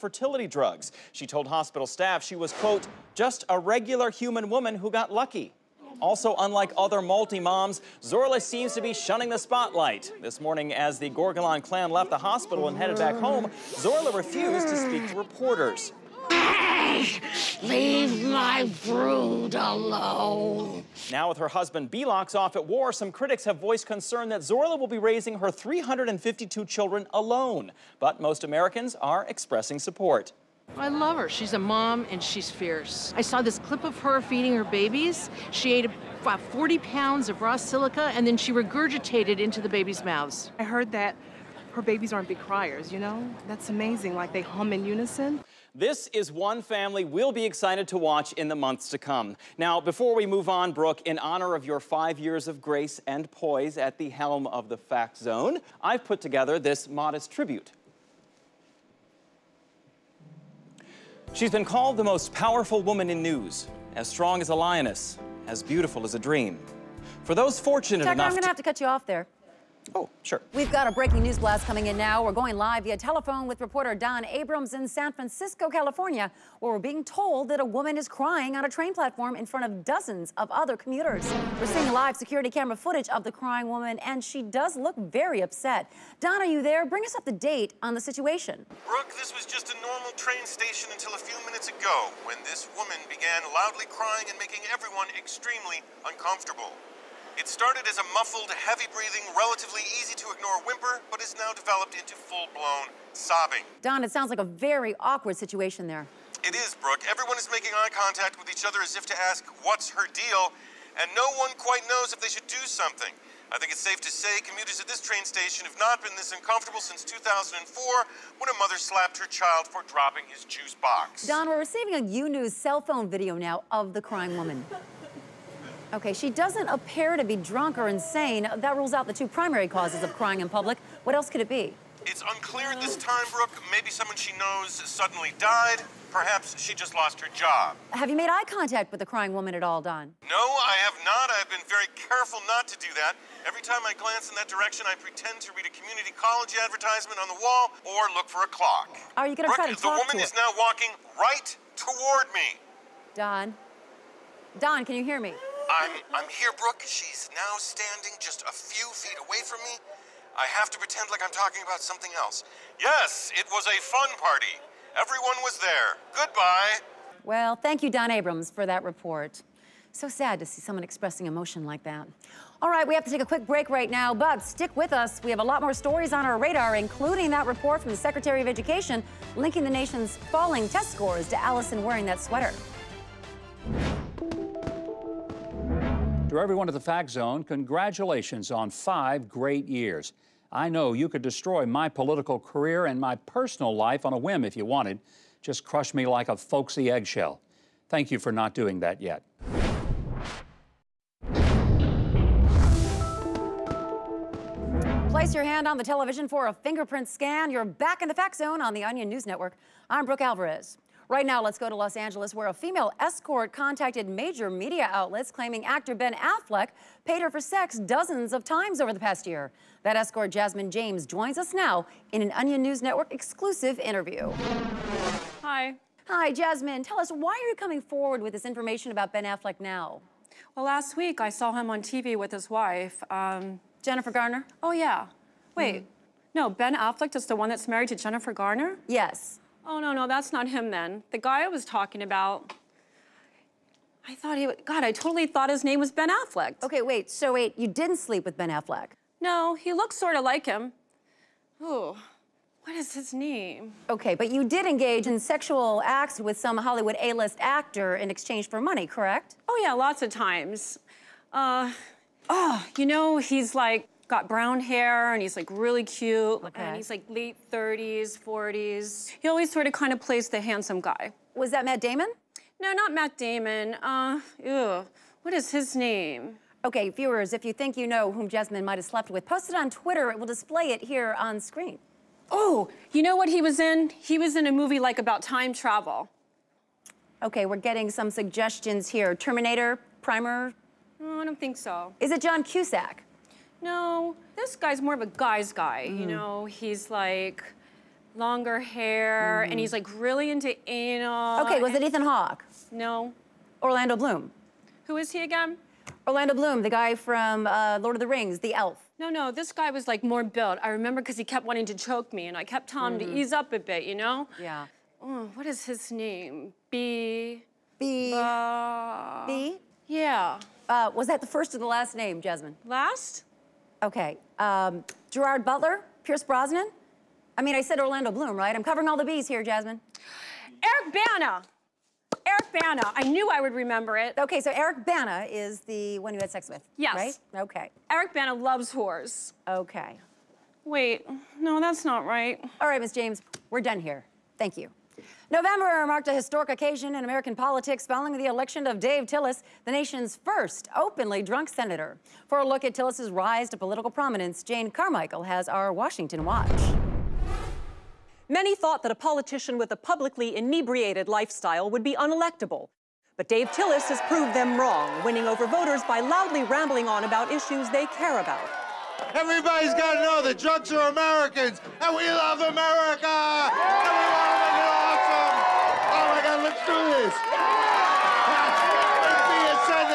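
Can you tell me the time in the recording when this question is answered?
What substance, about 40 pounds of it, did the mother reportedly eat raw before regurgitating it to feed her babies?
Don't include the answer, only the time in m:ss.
0:37.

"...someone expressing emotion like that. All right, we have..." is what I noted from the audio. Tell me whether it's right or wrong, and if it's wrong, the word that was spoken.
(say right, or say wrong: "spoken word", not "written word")
right.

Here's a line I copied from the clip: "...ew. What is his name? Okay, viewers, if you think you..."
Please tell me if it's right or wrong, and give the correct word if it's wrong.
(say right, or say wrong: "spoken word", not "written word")
right.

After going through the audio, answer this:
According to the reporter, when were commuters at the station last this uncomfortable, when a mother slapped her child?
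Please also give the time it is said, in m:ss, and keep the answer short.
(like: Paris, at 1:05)
2004, at 1:57.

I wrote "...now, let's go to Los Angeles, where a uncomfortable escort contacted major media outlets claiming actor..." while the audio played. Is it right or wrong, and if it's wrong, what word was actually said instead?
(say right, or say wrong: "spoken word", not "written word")
wrong: "female", not "uncomfortable".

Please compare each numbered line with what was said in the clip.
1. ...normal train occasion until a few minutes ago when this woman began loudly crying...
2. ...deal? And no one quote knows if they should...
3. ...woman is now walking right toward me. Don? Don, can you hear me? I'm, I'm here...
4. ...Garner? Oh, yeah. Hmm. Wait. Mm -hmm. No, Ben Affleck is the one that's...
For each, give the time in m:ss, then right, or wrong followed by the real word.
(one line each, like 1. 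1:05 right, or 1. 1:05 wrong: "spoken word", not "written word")
1. 1:29 wrong: "station", not "occasion"
2. 1:50 wrong: "quite", not "quote"
3. 2:29 right
4. 3:54 right.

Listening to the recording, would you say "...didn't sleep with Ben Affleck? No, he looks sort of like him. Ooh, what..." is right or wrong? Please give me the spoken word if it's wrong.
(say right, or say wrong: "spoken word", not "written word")
right.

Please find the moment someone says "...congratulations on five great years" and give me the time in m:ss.
3:07.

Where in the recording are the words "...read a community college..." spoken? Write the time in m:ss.
2:25.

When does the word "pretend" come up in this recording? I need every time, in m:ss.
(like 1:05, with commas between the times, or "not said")
2:24, 2:40.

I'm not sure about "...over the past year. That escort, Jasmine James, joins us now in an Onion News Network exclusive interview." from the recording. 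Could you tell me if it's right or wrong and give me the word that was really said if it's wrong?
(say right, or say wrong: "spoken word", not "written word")
right.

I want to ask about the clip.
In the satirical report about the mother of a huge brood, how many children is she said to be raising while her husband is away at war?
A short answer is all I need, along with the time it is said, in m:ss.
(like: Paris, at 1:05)
352, at 0:25.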